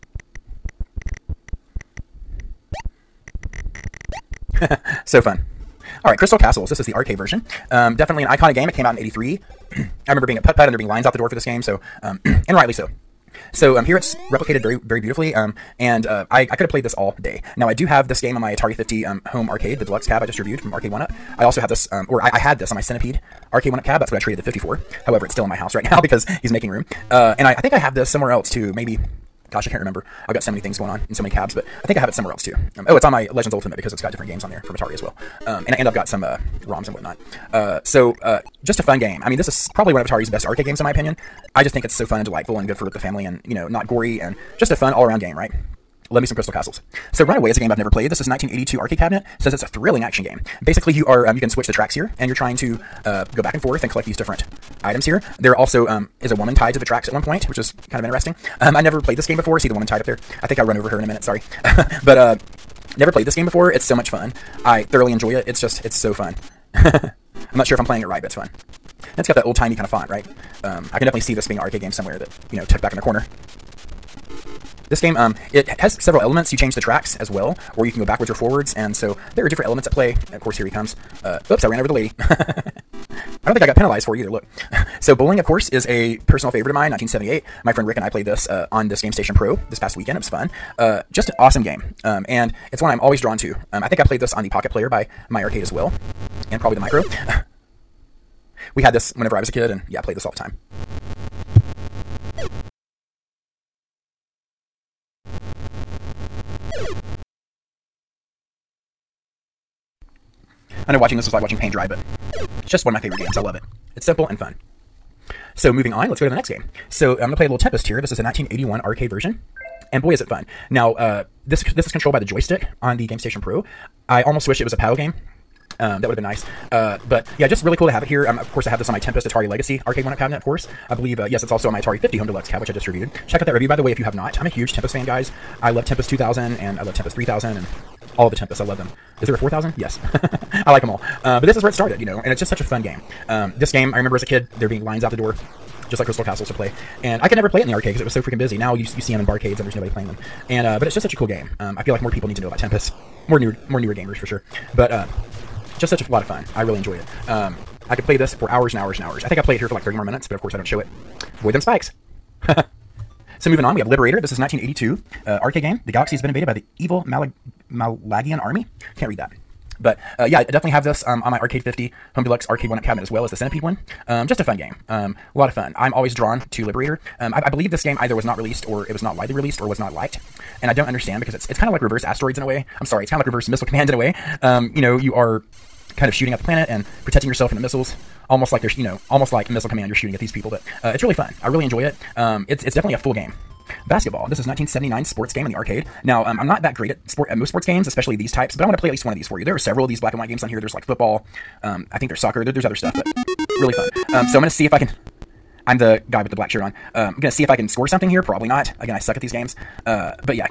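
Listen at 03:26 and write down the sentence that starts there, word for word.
Um, I'm gonna see if I can score something here.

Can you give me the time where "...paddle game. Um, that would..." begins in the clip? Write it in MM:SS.
02:04.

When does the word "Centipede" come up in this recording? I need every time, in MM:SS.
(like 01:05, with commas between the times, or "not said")
00:22, 02:53.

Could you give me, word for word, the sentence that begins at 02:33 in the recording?
More new, more newer gamers for sure.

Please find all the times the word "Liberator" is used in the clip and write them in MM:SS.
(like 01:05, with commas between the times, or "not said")
02:43, 02:56.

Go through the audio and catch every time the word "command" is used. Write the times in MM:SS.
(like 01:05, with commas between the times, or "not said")
03:03, 03:09.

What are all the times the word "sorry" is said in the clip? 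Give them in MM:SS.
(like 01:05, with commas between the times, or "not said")
01:01, 03:02.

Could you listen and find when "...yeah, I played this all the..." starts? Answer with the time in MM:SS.
01:39.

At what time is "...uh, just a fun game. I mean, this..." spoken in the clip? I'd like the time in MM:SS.
00:38.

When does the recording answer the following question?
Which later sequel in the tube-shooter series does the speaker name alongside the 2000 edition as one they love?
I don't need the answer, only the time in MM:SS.
02:16.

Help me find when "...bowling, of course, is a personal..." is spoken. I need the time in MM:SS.
01:25.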